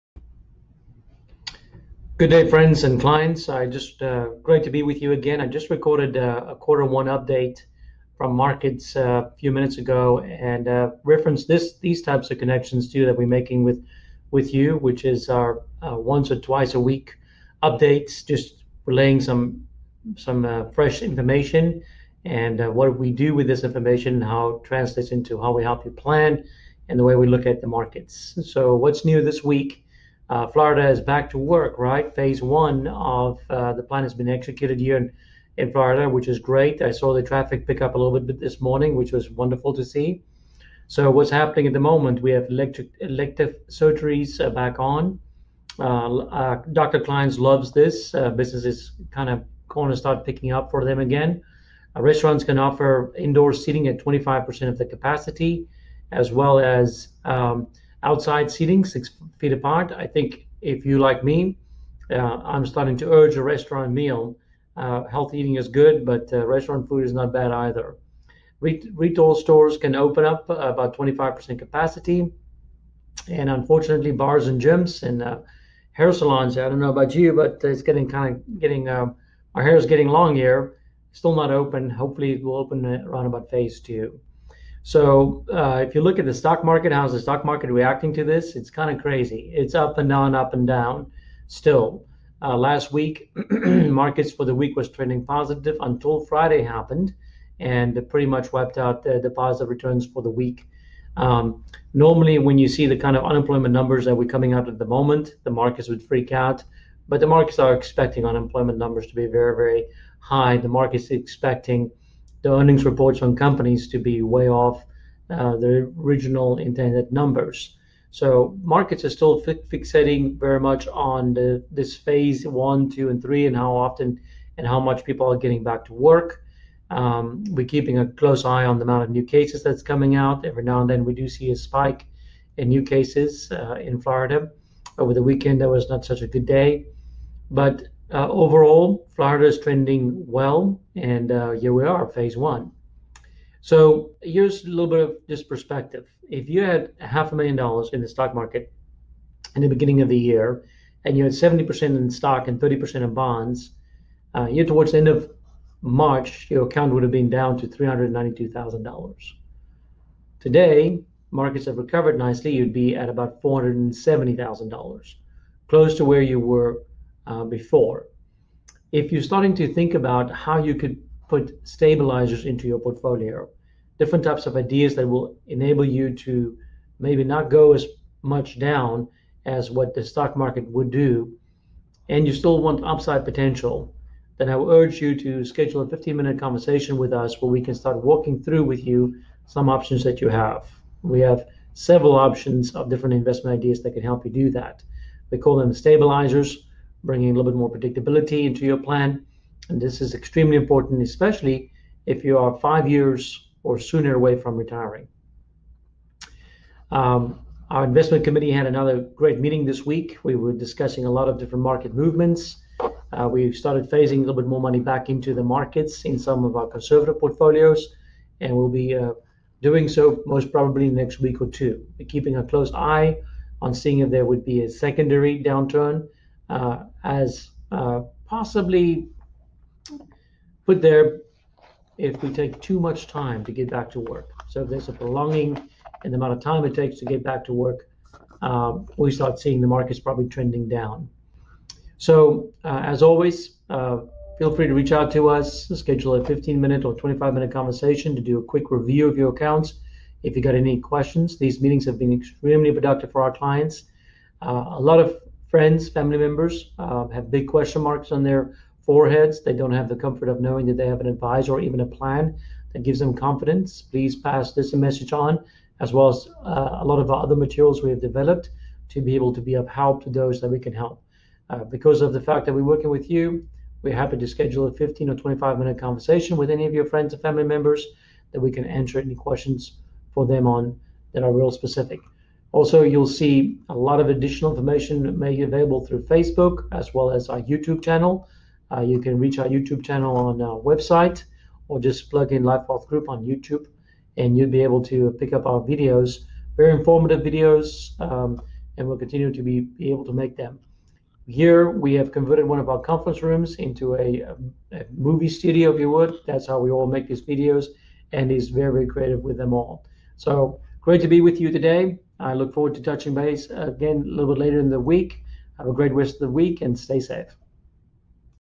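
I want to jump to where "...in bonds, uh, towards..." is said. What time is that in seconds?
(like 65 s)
152 s.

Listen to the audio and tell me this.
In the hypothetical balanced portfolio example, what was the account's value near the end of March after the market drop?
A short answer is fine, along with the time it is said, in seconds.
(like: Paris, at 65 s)
$392,000, at 157 s.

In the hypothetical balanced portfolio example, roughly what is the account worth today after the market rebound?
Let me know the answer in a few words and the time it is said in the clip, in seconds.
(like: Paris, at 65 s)
$470,000, at 163 s.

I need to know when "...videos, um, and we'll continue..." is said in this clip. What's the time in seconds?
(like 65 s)
297 s.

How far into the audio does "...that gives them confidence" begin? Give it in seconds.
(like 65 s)
262 s.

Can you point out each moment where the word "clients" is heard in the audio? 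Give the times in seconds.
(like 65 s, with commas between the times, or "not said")
3 s, 253 s.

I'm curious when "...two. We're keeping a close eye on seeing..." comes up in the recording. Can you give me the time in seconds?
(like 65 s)
221 s.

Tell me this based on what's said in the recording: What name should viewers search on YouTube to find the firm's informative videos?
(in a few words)
Life Group.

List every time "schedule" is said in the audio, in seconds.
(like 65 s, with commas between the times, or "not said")
185 s, 245 s, 274 s.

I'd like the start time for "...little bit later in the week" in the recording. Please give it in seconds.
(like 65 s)
314 s.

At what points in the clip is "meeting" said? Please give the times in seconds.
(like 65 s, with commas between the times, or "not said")
209 s, 251 s.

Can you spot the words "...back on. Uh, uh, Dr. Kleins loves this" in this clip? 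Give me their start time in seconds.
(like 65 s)
44 s.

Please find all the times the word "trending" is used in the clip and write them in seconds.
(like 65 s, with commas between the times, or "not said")
94 s, 139 s, 240 s.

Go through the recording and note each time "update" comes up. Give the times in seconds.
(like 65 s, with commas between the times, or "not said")
7 s, 17 s.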